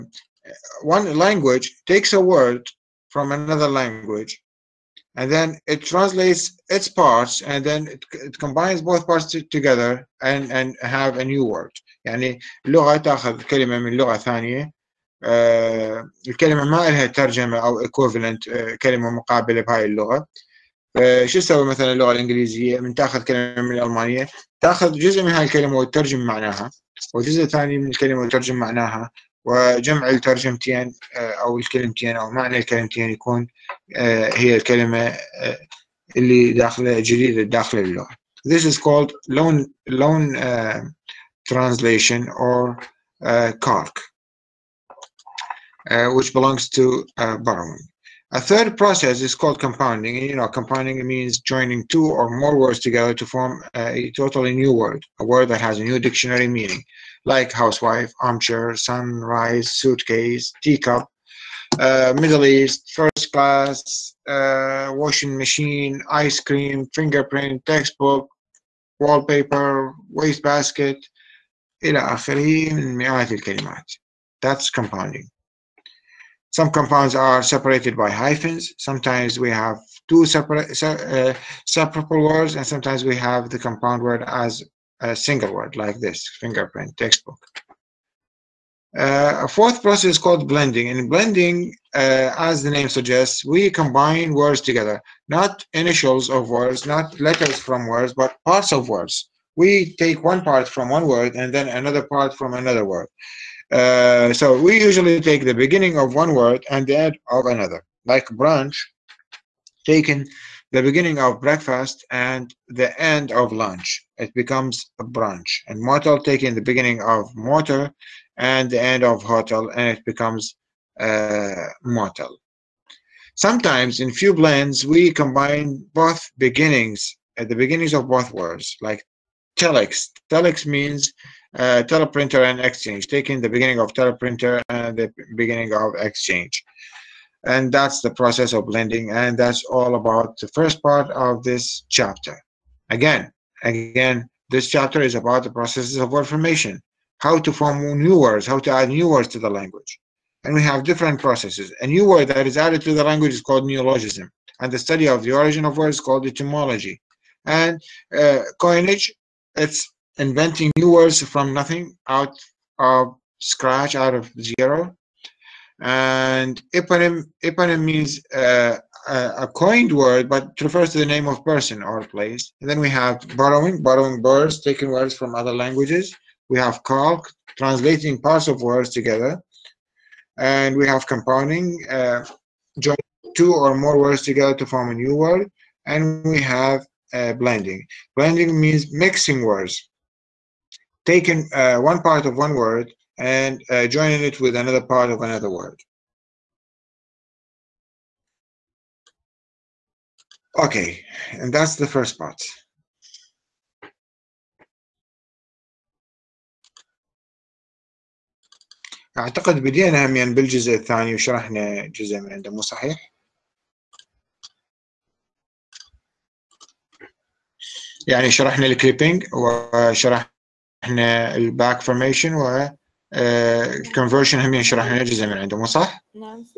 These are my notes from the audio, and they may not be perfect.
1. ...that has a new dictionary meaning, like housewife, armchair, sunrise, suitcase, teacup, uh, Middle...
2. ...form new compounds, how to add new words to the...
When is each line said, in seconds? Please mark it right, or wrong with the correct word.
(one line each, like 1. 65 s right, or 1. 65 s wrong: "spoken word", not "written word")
1. 55 s right
2. 147 s wrong: "words", not "compounds".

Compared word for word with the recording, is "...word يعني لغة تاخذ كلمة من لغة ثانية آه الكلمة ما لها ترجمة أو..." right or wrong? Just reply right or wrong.
right.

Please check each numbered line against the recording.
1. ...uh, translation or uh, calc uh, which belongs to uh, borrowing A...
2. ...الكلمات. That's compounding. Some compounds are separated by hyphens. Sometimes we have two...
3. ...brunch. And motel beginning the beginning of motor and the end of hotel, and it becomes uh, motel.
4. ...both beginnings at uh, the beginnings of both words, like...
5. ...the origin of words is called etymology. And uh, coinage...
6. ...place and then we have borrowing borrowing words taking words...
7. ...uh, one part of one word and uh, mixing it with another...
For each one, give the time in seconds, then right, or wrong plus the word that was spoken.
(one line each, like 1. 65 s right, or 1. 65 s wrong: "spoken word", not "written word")
1. 40 s right
2. 73 s right
3. 115 s wrong: "taking", not "beginning"
4. 125 s right
5. 155 s right
6. 172 s right
7. 191 s wrong: "joining", not "mixing".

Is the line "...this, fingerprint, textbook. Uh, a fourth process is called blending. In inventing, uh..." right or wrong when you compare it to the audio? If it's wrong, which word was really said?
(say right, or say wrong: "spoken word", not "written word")
wrong: "blending", not "inventing".